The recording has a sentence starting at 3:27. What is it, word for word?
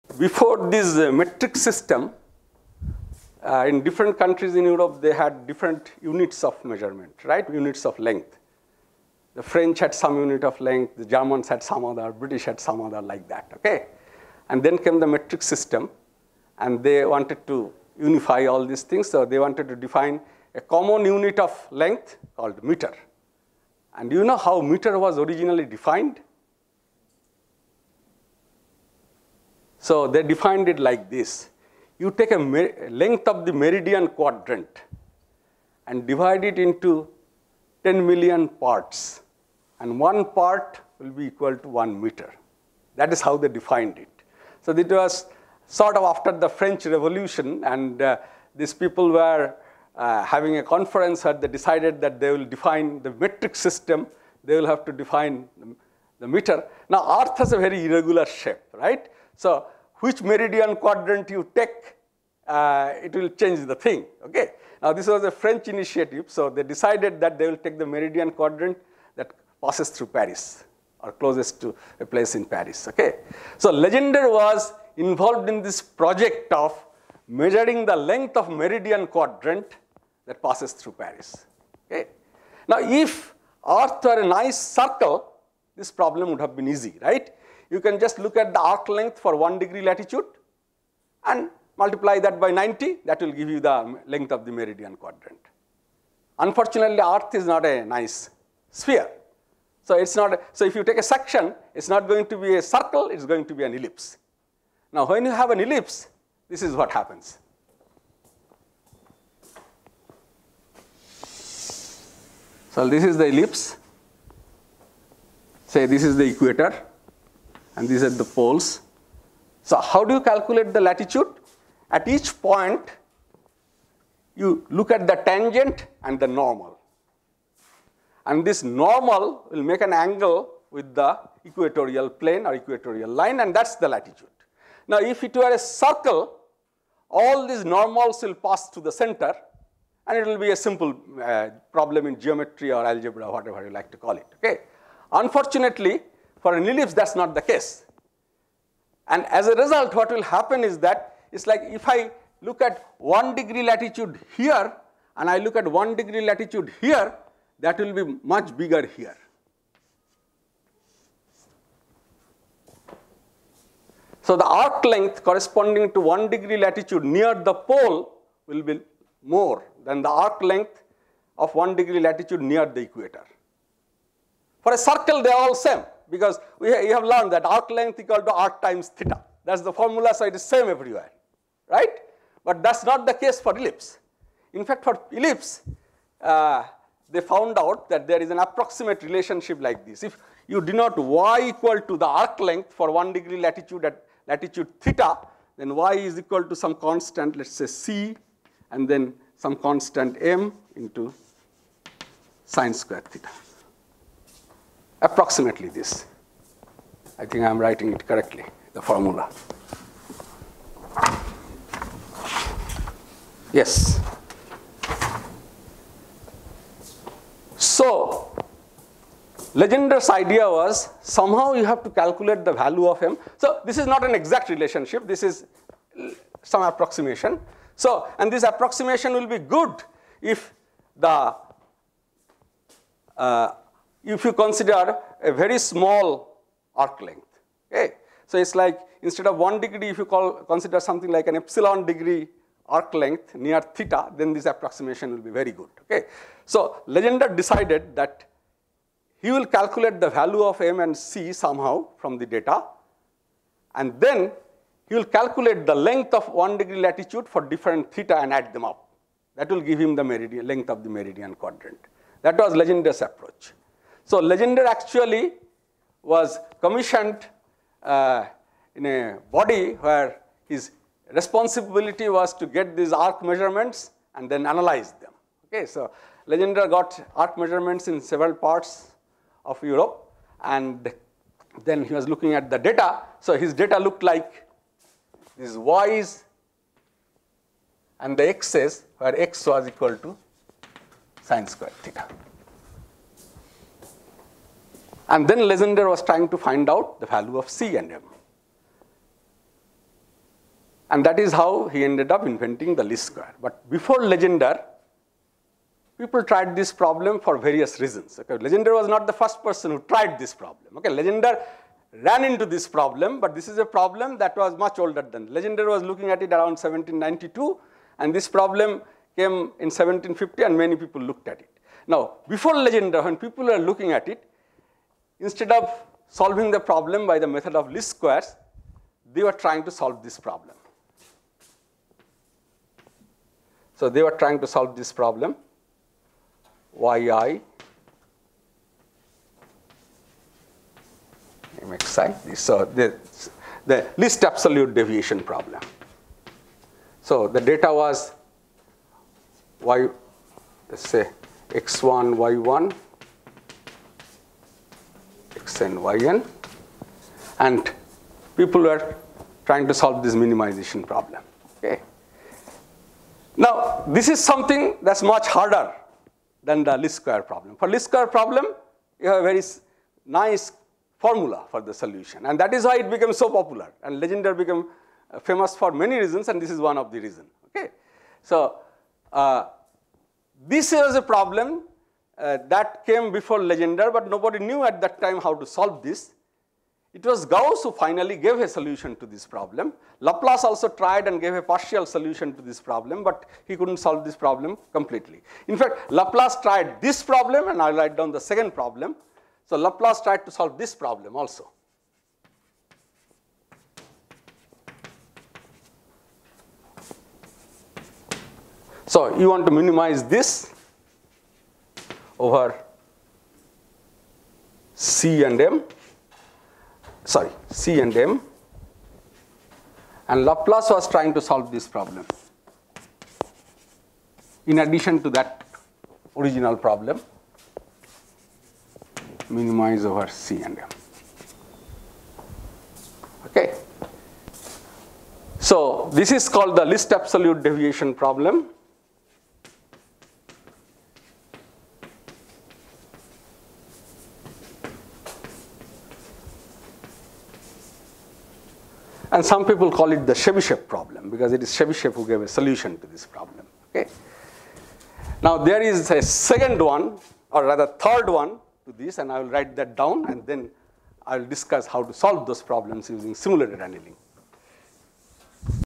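I think I'm writing it correctly, the formula.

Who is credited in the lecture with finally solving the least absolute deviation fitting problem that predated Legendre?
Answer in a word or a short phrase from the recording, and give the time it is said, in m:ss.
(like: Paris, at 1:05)
Gauss, at 6:27.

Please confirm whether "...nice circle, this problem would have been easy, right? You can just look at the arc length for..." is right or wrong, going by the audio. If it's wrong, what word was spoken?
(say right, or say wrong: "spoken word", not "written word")
right.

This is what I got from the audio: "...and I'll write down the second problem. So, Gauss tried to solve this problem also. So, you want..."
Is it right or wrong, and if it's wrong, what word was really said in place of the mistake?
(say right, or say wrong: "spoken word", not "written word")
wrong: "Laplace", not "Gauss".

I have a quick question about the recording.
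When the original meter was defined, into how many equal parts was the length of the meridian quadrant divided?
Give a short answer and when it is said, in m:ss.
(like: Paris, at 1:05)
10 million, at 0:37.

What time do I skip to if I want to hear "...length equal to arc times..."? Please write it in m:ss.
2:57.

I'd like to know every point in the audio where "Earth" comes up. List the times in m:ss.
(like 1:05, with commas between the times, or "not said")
0:57, 1:23, 1:37.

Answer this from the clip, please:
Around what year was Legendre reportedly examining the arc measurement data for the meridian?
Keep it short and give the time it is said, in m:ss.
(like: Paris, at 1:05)
1792, at 5:16.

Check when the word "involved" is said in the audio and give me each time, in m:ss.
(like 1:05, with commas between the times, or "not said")
1:14.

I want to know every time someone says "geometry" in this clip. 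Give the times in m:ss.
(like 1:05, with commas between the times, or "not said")
2:22.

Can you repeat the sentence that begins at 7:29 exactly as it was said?
And some people call it the Chebyshev problem because it is Chebyshev who gave a solution to this problem.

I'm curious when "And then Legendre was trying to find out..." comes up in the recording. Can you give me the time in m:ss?
4:55.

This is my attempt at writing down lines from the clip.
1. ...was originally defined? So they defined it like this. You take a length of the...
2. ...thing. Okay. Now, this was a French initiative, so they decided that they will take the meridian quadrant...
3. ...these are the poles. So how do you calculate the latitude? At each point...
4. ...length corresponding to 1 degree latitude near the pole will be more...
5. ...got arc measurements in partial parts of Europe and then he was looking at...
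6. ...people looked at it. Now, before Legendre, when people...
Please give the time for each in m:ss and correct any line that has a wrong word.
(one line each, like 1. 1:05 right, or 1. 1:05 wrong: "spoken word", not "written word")
1. 0:24 right
2. 1:03 right
3. 1:57 right
4. 2:44 right
5. 4:36 wrong: "several", not "partial"
6. 5:20 right.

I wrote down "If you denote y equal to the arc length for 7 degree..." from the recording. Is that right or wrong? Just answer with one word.
wrong.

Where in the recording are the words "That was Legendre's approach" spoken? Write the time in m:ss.
4:22.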